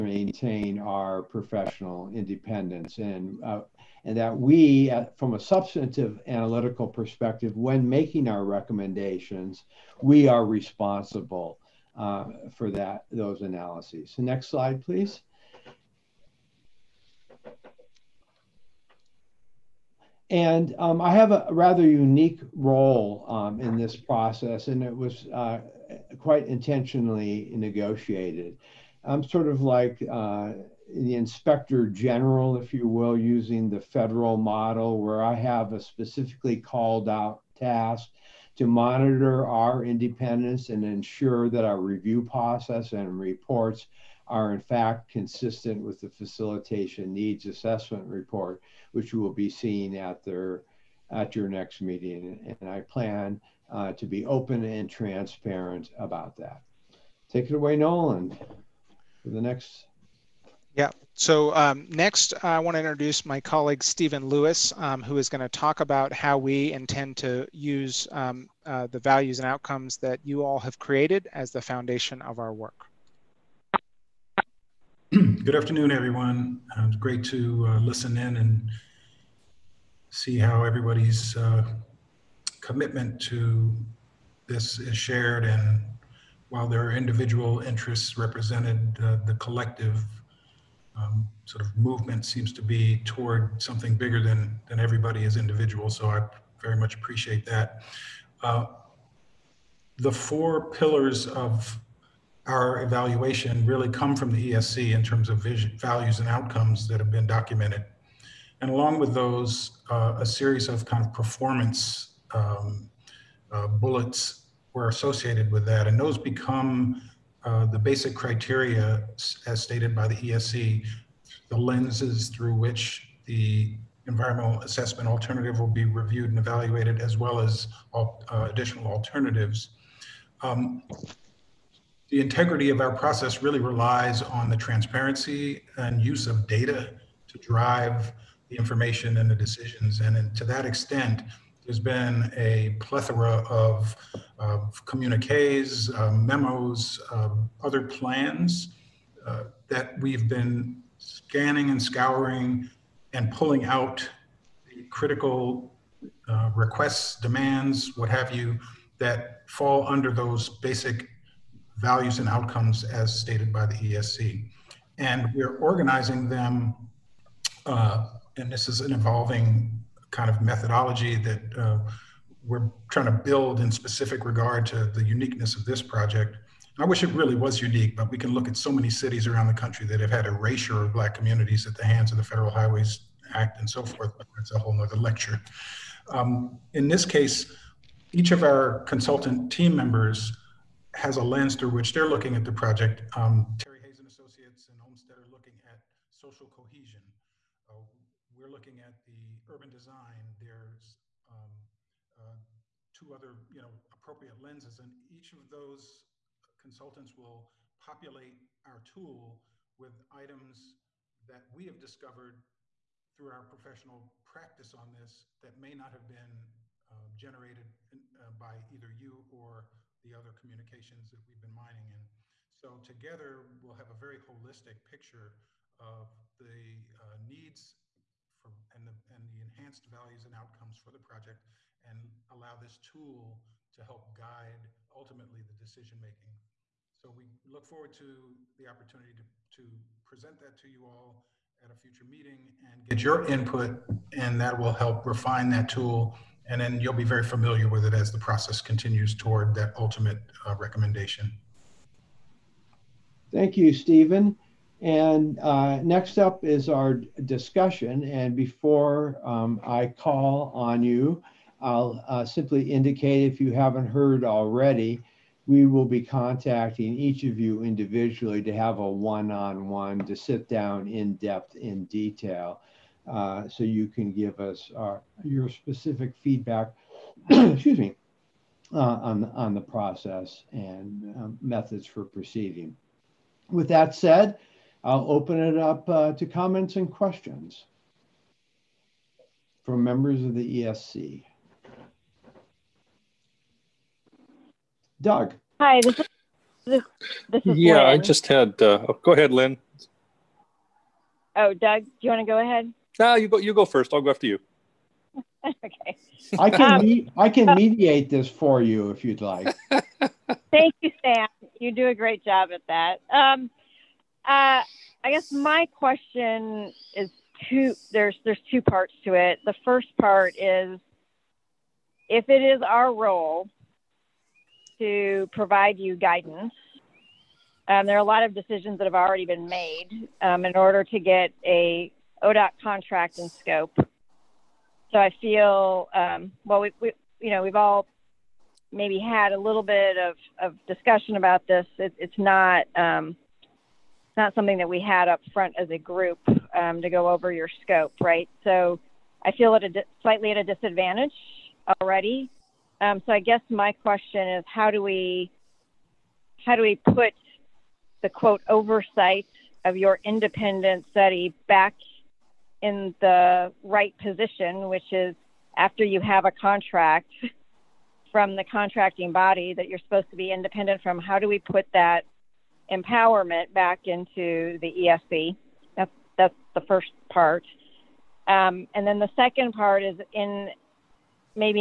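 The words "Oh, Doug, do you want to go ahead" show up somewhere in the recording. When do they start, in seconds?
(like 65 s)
301 s.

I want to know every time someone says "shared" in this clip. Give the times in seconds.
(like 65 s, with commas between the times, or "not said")
84 s.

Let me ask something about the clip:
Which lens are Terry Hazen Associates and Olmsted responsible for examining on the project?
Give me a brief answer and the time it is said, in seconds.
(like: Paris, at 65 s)
social cohesion, at 196 s.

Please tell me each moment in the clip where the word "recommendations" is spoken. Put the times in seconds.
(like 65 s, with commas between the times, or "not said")
8 s, 250 s.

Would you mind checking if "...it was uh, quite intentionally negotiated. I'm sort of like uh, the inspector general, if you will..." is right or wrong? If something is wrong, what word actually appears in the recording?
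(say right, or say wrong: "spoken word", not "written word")
right.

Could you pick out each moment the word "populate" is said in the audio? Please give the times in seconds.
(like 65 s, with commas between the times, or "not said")
207 s.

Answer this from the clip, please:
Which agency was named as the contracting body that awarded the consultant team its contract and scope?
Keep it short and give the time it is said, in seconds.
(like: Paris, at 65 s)
ODOT, at 332 s.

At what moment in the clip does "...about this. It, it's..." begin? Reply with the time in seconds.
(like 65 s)
341 s.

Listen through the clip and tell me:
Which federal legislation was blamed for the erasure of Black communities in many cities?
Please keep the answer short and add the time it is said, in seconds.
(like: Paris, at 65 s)
Federal Highways Act, at 182 s.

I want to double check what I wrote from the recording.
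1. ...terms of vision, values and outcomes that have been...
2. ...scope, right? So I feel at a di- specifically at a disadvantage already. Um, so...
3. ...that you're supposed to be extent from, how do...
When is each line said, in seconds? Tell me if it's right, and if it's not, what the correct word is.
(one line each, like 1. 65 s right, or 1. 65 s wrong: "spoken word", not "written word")
1. 105 s right
2. 347 s wrong: "slightly", not "specifically"
3. 369 s wrong: "independent", not "extent".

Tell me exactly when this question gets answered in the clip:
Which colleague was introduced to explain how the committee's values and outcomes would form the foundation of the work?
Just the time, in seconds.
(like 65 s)
63 s.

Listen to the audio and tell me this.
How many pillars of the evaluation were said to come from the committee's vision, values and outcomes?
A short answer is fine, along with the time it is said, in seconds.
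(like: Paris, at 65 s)
four, at 100 s.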